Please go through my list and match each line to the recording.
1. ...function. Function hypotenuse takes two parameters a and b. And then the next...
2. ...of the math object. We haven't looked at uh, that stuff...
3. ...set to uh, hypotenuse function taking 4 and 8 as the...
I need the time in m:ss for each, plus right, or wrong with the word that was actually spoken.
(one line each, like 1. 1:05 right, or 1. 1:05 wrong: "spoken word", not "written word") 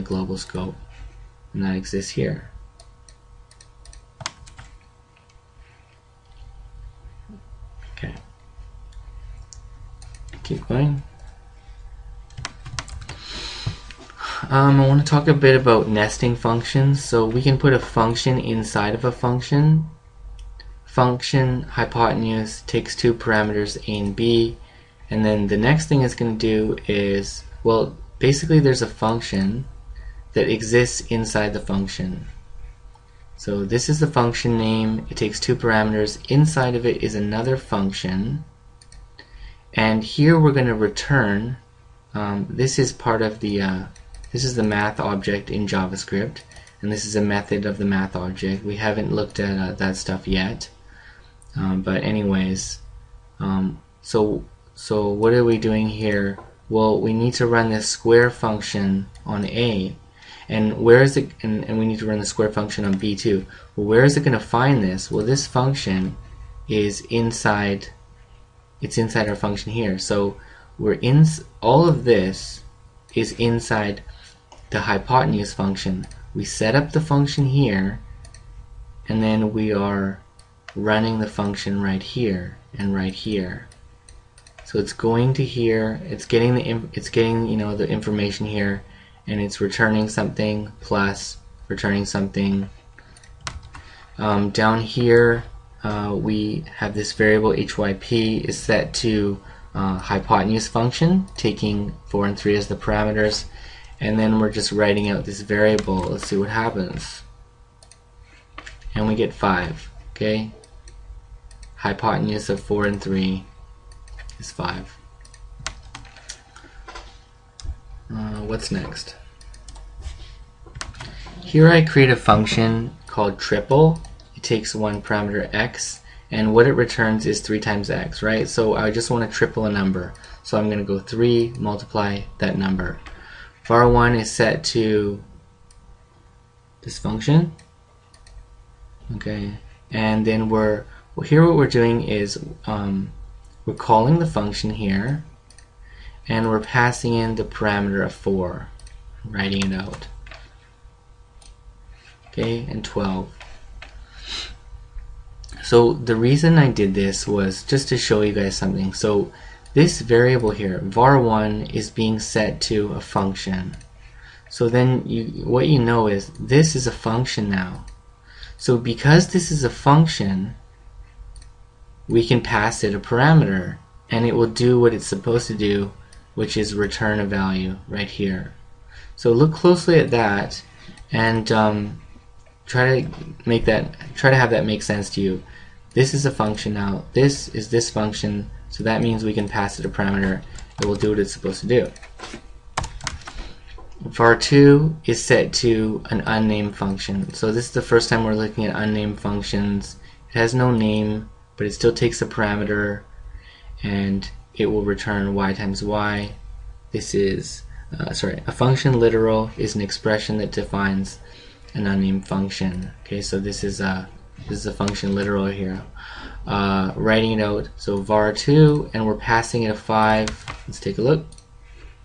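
1. 0:19 right
2. 0:47 right
3. 1:38 wrong: "3", not "8".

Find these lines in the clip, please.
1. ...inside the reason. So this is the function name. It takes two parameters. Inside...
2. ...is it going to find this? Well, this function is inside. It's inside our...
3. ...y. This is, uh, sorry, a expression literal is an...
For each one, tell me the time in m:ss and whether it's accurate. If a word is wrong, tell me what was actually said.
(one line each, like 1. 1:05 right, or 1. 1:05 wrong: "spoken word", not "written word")
1. 0:31 wrong: "function", not "reason"
2. 1:04 right
3. 3:25 wrong: "function", not "expression".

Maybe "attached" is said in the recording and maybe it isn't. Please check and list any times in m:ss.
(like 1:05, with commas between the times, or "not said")
not said.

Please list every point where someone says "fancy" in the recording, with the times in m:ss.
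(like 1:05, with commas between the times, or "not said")
not said.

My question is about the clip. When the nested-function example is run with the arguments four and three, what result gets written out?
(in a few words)
5.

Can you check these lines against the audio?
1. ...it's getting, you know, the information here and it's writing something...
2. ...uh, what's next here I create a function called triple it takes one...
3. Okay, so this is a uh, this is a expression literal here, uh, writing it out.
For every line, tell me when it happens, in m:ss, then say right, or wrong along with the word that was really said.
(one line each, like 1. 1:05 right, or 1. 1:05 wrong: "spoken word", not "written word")
1. 1:26 wrong: "returning", not "writing"
2. 1:58 right
3. 3:33 wrong: "function", not "expression".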